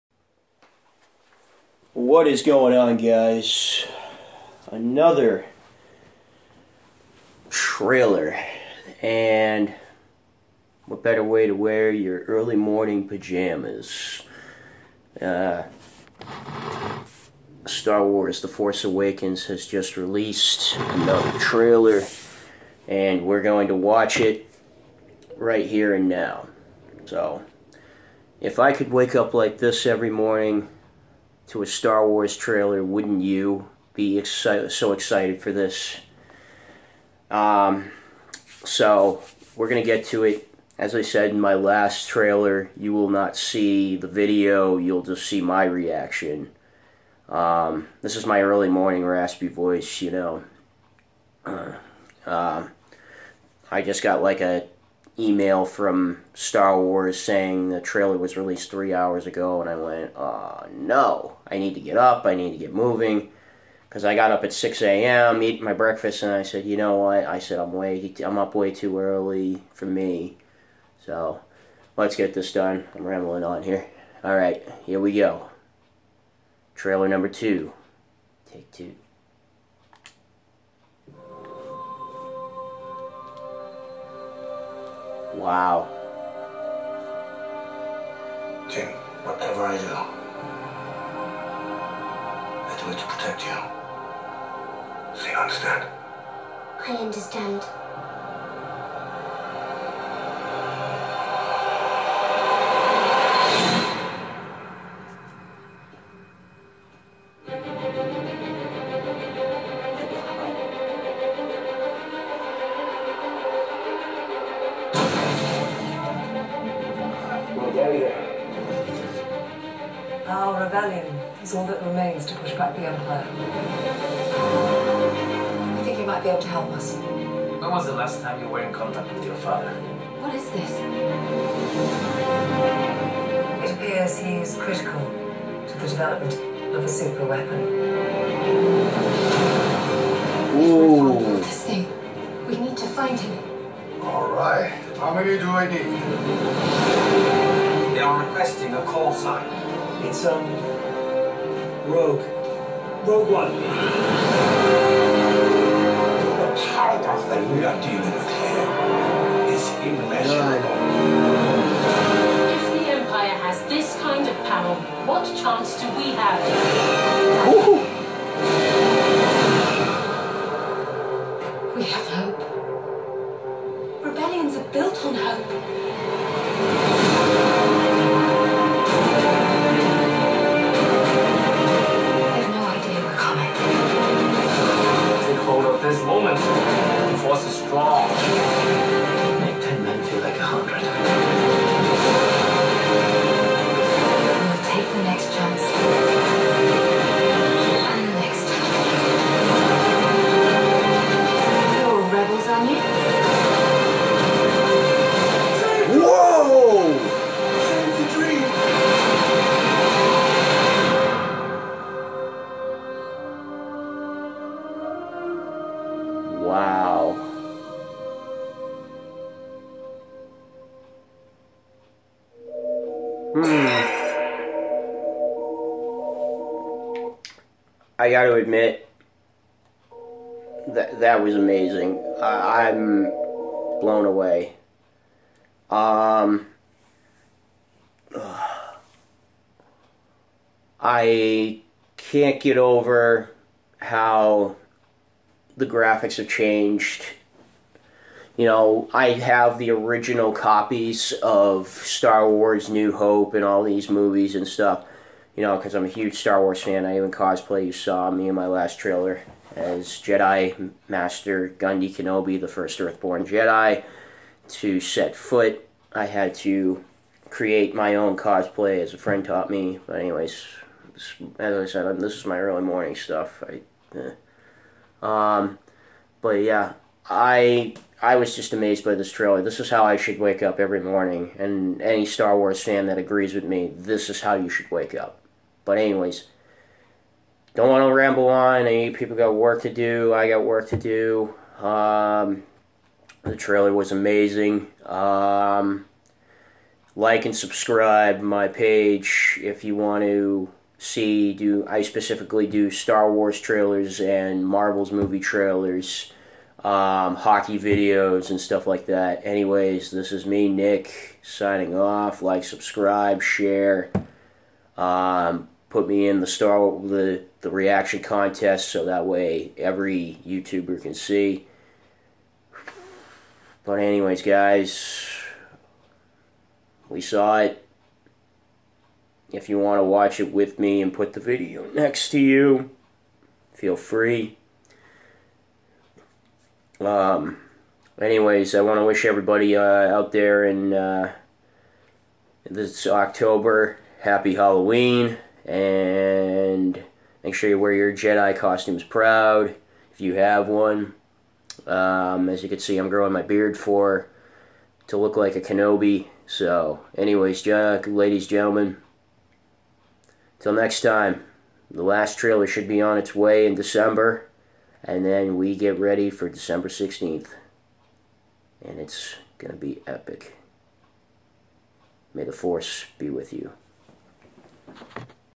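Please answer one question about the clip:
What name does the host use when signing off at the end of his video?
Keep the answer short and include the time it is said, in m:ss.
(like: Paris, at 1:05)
Nick, at 5:10.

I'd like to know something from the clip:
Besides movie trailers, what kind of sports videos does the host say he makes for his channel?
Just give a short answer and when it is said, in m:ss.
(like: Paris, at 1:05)
hockey videos, at 5:07.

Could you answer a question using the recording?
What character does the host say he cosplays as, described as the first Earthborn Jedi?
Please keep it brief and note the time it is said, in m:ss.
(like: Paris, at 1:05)
Gundy Kenobi, at 4:21.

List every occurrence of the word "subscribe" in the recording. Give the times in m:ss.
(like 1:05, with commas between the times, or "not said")
4:57, 5:12.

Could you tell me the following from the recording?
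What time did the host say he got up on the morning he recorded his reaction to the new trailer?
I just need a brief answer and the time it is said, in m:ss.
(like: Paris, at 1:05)
6 a.m., at 1:04.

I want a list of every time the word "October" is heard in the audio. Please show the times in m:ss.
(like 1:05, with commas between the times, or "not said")
5:42.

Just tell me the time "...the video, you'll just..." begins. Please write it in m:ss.
0:43.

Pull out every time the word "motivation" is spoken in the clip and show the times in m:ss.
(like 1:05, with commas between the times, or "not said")
not said.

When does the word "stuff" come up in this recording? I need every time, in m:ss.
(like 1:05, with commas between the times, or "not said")
4:14, 4:32, 5:08.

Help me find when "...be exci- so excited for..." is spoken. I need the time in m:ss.
0:33.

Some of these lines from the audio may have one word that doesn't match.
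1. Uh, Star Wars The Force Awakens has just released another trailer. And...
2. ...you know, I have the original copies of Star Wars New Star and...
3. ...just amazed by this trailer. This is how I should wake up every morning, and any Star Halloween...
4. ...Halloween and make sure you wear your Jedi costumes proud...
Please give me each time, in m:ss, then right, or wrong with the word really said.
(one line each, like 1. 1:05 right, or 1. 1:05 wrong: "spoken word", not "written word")
1. 0:15 right
2. 4:08 wrong: "Hope", not "Star"
3. 4:38 wrong: "Wars", not "Halloween"
4. 5:44 right.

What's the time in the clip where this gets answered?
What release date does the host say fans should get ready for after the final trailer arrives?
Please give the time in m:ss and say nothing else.
6:06.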